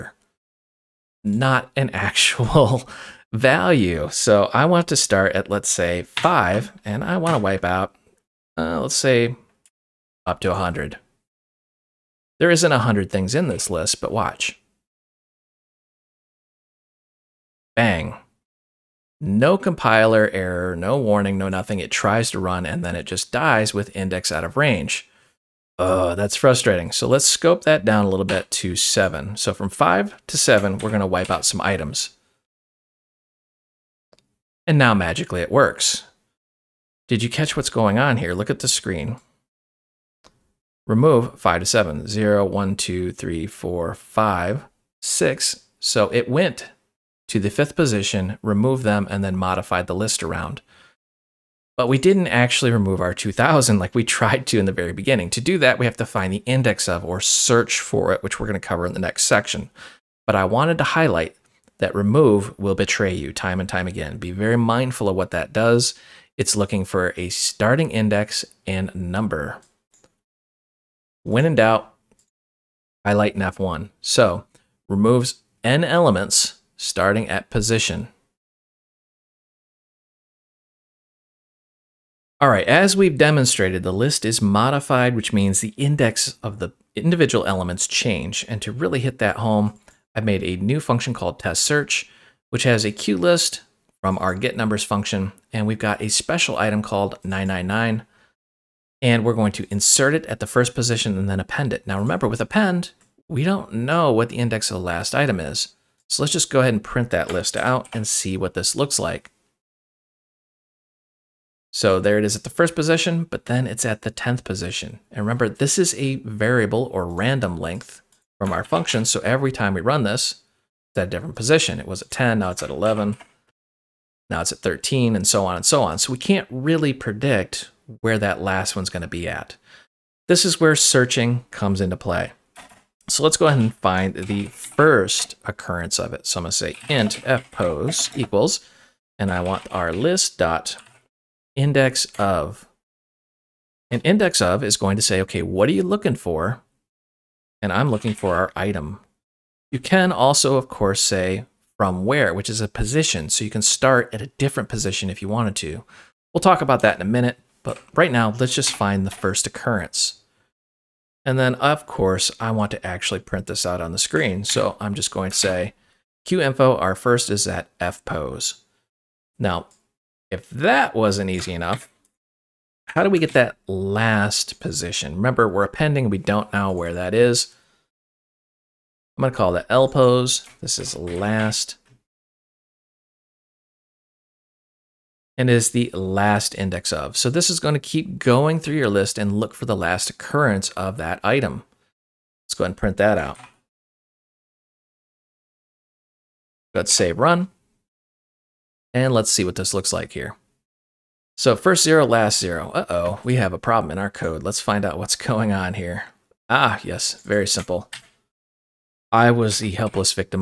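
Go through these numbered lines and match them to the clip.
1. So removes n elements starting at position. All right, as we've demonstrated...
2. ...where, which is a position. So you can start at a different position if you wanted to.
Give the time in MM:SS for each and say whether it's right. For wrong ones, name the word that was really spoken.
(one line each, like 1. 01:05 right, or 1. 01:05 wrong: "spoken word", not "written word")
1. 01:13 right
2. 02:32 right.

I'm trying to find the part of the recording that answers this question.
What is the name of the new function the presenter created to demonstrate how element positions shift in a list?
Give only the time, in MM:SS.
01:31.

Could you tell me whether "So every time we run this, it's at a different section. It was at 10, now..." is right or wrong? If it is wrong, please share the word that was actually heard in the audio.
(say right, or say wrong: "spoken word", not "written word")
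wrong: "position", not "section".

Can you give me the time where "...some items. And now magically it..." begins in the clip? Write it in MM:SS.
00:31.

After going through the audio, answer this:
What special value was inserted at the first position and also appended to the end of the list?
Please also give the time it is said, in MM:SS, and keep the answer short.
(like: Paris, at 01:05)
999, at 01:37.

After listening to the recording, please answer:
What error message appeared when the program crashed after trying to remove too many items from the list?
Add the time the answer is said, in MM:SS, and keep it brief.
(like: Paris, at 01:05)
index out of range, at 00:23.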